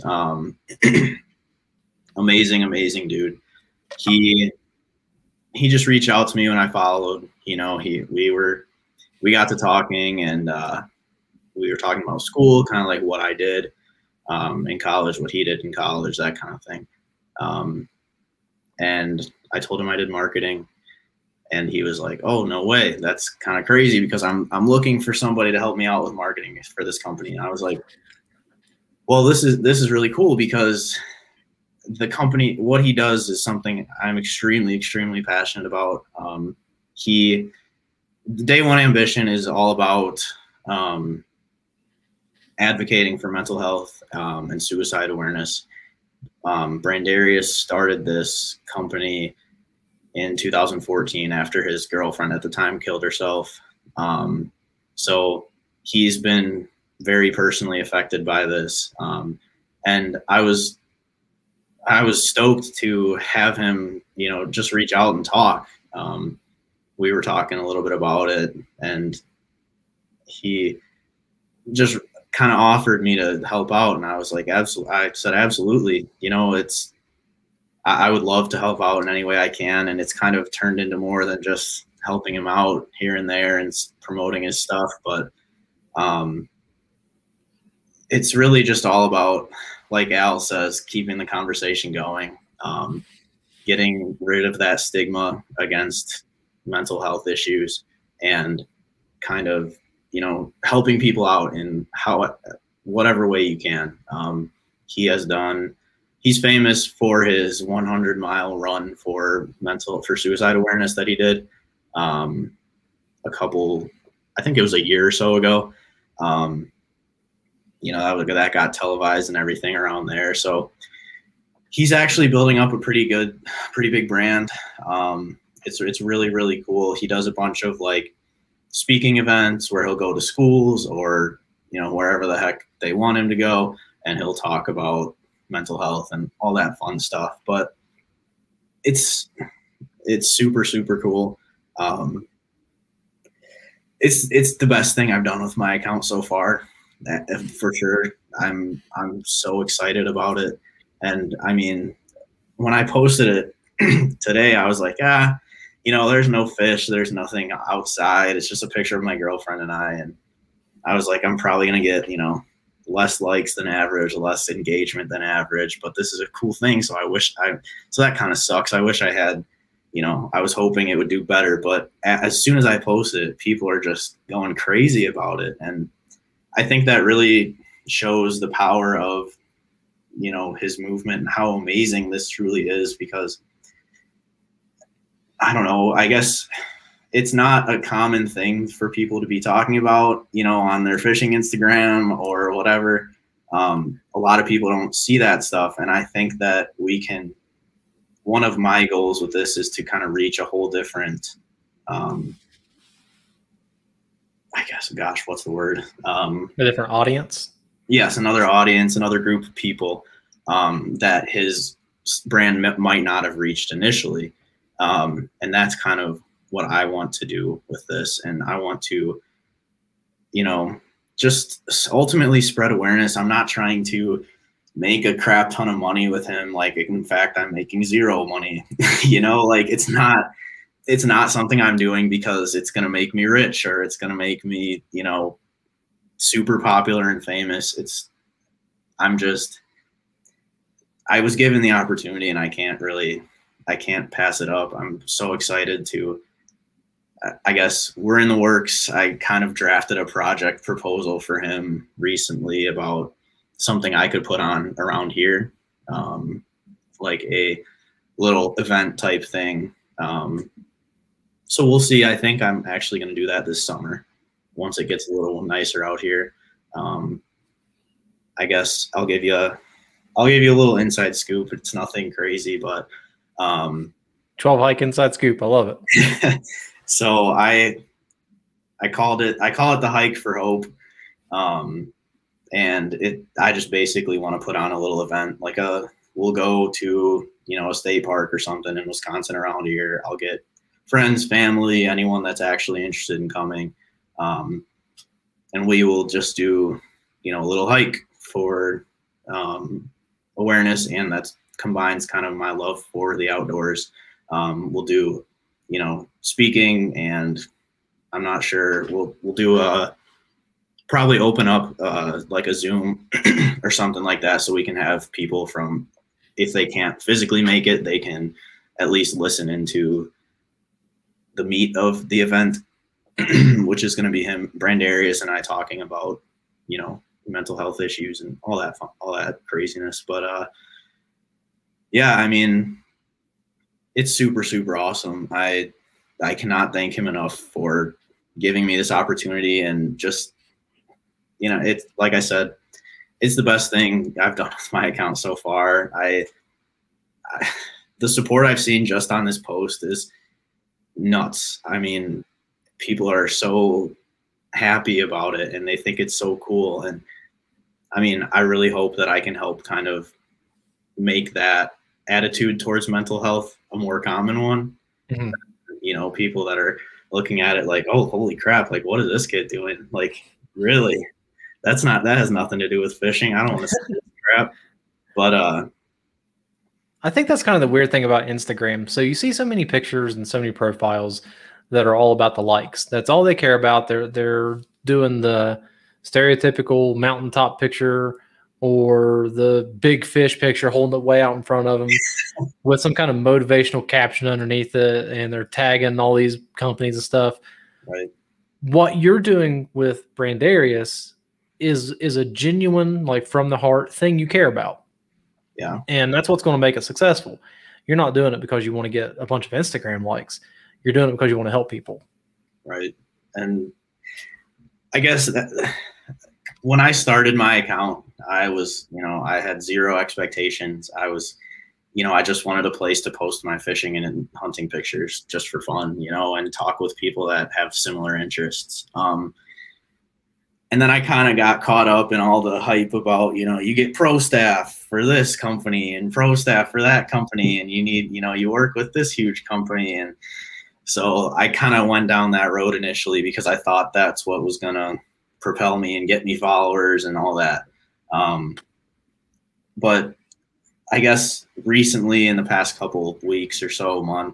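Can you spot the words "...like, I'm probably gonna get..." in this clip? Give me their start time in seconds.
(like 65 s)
161 s.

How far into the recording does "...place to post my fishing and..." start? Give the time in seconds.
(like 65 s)
422 s.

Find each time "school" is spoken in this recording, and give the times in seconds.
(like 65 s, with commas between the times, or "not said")
12 s, 130 s.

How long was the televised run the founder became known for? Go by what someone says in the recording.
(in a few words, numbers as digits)
100 miles.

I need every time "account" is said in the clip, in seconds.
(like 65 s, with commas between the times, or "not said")
145 s, 344 s, 417 s.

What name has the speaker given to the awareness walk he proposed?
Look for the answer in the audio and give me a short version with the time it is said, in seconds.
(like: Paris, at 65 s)
Hike for Hope, at 279 s.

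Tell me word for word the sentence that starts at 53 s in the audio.
Um, so he's been very personally affected by this.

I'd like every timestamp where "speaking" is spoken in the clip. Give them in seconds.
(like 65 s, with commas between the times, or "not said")
128 s, 306 s.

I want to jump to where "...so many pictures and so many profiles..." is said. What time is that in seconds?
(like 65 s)
379 s.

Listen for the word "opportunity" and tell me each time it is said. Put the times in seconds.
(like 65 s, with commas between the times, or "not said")
241 s, 338 s.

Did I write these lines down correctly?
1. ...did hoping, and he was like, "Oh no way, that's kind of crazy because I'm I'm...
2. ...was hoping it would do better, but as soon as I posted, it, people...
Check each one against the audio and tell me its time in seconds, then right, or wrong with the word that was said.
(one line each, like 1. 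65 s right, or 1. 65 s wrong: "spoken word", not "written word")
1. 19 s wrong: "marketing", not "hoping"
2. 170 s right.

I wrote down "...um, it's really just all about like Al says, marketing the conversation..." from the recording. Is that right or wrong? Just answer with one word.
wrong.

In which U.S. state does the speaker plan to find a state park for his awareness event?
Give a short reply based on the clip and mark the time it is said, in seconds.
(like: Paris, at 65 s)
Wisconsin, at 288 s.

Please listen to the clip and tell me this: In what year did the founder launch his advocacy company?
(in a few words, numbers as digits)
2014.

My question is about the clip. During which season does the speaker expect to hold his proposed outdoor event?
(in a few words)
Summer.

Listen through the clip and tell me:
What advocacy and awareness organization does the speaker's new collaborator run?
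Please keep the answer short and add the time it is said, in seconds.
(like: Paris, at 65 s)
Day One Ambition, at 38 s.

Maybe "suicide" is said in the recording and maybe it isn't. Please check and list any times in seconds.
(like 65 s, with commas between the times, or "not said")
44 s, 110 s.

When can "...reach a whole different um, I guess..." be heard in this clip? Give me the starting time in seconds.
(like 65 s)
200 s.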